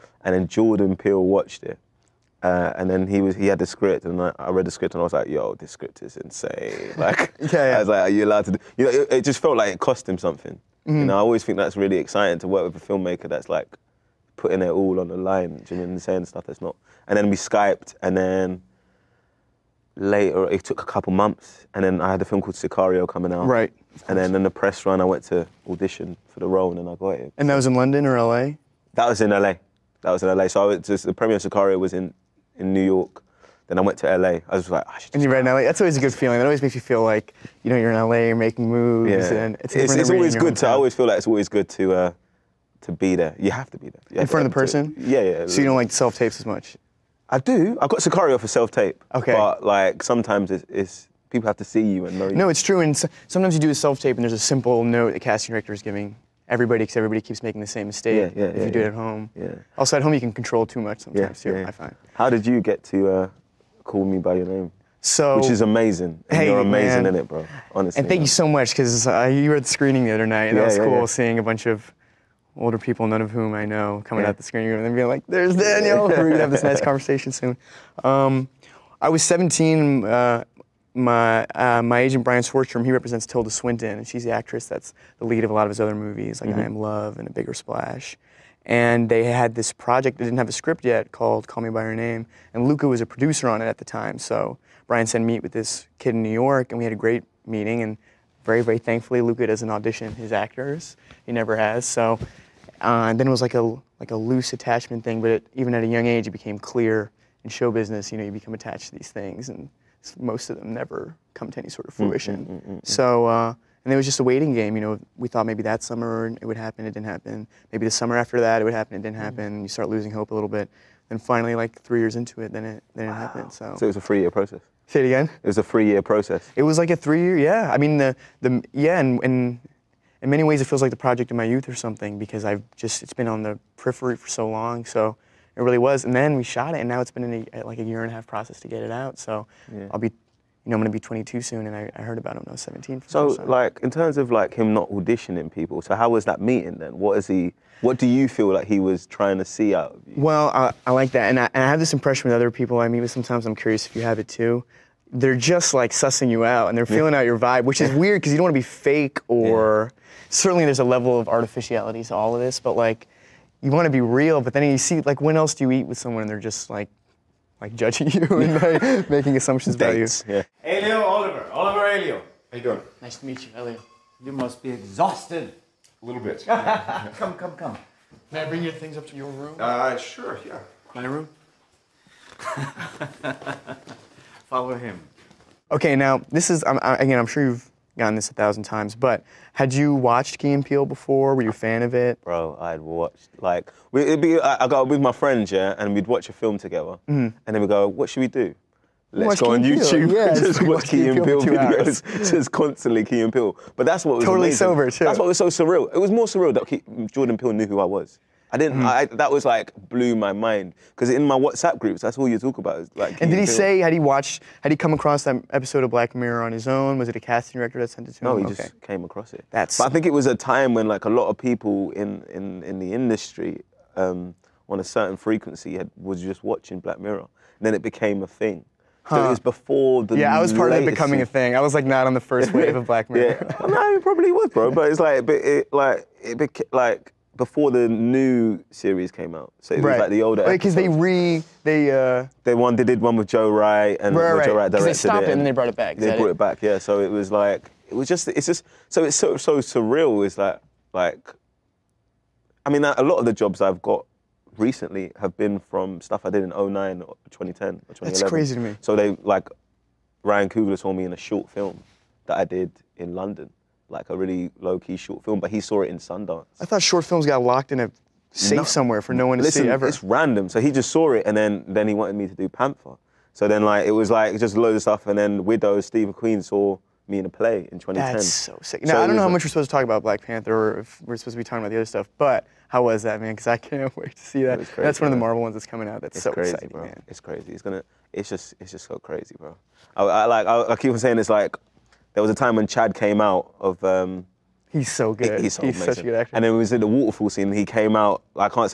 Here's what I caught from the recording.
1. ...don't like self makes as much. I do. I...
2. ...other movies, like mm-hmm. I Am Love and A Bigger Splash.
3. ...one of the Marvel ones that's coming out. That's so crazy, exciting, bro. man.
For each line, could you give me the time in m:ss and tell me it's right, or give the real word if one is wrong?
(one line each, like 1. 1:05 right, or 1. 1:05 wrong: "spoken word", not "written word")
1. 0:45 wrong: "tapes", not "makes"
2. 1:25 right
3. 4:44 right.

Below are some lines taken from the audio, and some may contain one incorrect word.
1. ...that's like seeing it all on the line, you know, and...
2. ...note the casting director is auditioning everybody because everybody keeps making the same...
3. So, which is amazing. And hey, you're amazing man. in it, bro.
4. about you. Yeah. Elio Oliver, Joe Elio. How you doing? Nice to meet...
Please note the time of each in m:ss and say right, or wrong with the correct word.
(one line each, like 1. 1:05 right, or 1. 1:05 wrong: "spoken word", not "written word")
1. 0:13 wrong: "putting", not "seeing"
2. 0:54 wrong: "giving", not "auditioning"
3. 1:05 right
4. 2:50 wrong: "Oliver", not "Joe".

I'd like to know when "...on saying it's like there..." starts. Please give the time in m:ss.
4:50.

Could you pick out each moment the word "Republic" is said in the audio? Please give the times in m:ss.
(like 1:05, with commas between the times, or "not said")
not said.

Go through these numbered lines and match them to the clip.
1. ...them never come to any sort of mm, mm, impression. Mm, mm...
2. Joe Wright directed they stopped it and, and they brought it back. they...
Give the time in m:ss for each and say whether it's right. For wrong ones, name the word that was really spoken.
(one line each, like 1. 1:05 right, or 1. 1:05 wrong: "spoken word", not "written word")
1. 1:50 wrong: "fruition", not "impression"
2. 4:04 right.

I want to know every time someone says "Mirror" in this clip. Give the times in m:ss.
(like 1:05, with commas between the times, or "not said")
3:36, 3:46, 3:53.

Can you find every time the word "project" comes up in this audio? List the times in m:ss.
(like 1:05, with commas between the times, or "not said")
1:29, 2:10.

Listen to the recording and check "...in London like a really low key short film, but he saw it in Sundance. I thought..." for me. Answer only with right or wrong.
right.